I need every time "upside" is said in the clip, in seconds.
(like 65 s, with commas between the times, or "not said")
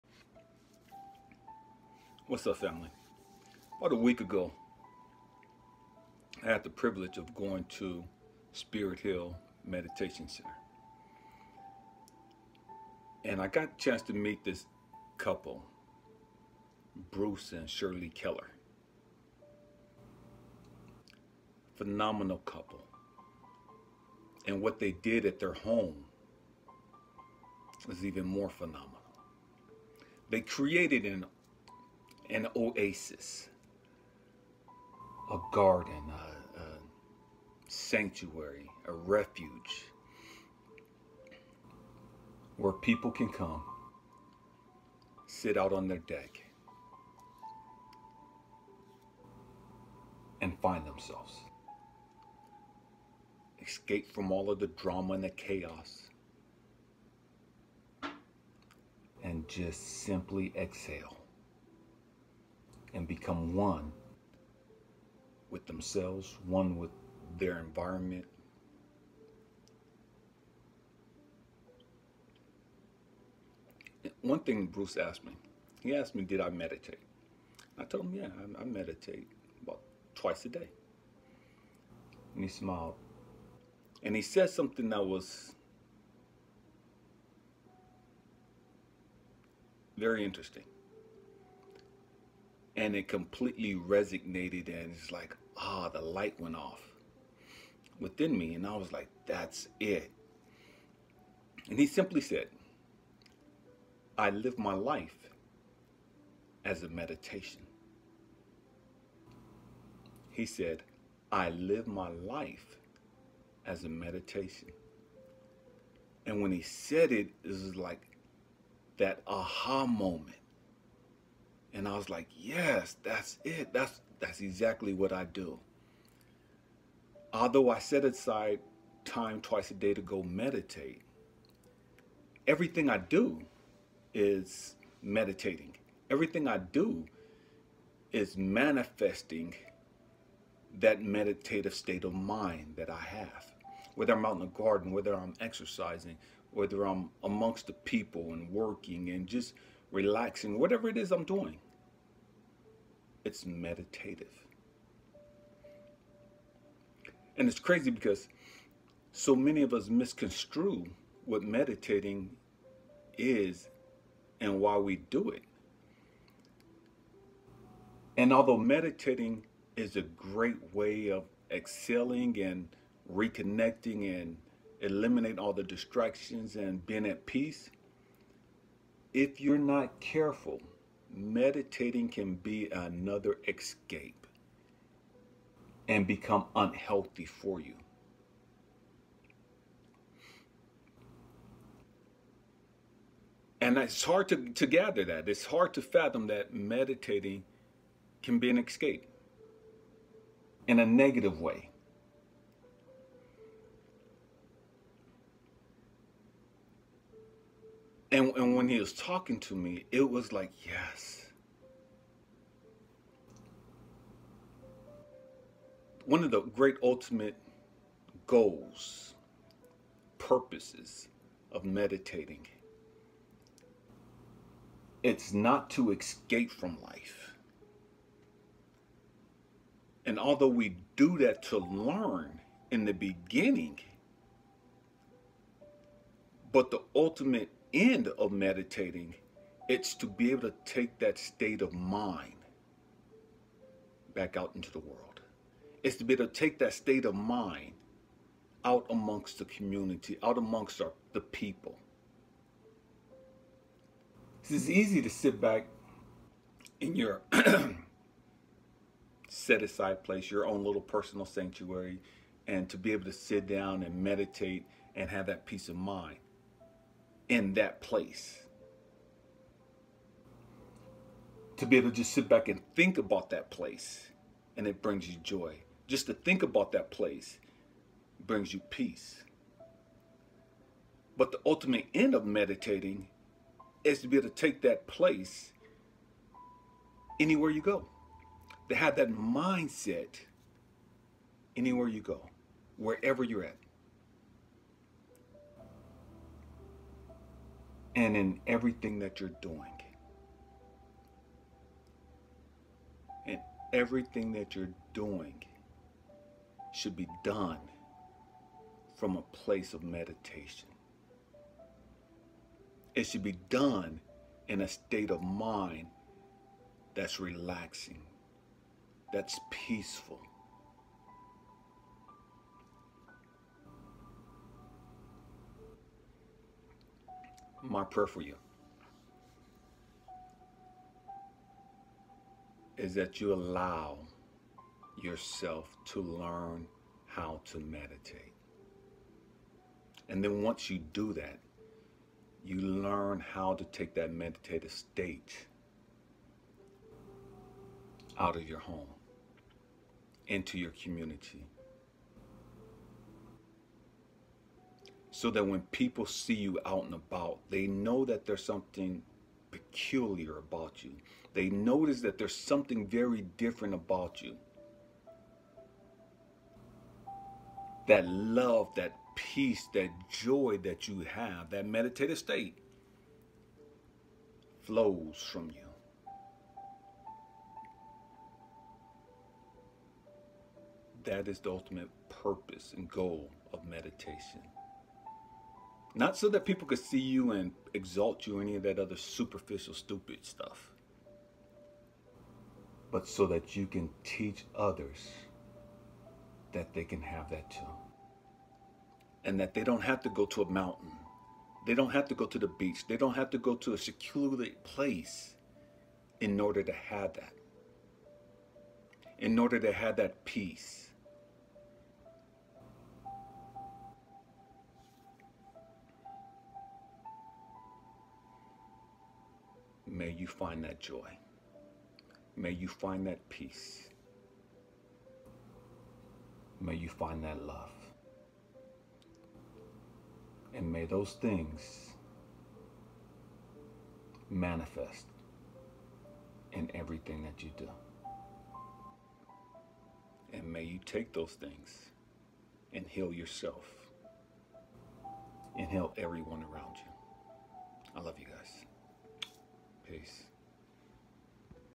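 not said.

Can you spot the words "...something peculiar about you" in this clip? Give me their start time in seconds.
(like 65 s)
358 s.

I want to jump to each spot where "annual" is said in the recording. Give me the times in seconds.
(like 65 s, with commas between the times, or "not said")
not said.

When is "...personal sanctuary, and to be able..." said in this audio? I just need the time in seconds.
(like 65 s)
260 s.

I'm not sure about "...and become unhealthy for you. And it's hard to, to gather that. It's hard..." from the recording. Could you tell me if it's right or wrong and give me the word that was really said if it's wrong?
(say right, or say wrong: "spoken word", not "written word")
right.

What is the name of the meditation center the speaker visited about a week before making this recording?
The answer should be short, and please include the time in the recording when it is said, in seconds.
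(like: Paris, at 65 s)
Spirit Hill Meditation Center, at 8 s.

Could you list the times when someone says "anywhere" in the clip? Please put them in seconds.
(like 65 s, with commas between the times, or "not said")
287 s, 291 s.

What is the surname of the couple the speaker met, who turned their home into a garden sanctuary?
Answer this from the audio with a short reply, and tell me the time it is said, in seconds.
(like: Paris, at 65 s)
Keller, at 18 s.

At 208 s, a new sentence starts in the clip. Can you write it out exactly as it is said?
And, and when he was talking to me, it was like, yes.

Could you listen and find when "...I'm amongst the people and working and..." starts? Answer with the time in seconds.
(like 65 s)
146 s.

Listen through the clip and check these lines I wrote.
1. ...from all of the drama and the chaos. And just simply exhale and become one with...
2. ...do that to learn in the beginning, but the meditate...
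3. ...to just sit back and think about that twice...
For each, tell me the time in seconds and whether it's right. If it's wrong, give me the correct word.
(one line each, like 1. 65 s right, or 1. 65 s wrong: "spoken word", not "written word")
1. 54 s right
2. 230 s wrong: "ultimate", not "meditate"
3. 271 s wrong: "place", not "twice".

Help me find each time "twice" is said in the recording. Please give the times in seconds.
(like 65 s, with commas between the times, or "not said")
80 s, 129 s.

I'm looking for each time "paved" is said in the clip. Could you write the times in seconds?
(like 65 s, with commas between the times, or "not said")
not said.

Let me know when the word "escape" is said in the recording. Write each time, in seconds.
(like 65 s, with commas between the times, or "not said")
53 s, 183 s, 198 s, 225 s.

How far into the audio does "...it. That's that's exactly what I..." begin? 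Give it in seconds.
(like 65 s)
123 s.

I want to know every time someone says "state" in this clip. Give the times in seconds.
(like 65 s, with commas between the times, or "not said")
141 s, 241 s, 246 s, 314 s, 344 s, 372 s.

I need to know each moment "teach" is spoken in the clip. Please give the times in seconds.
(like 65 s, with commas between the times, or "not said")
394 s.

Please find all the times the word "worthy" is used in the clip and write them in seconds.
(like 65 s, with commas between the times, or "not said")
not said.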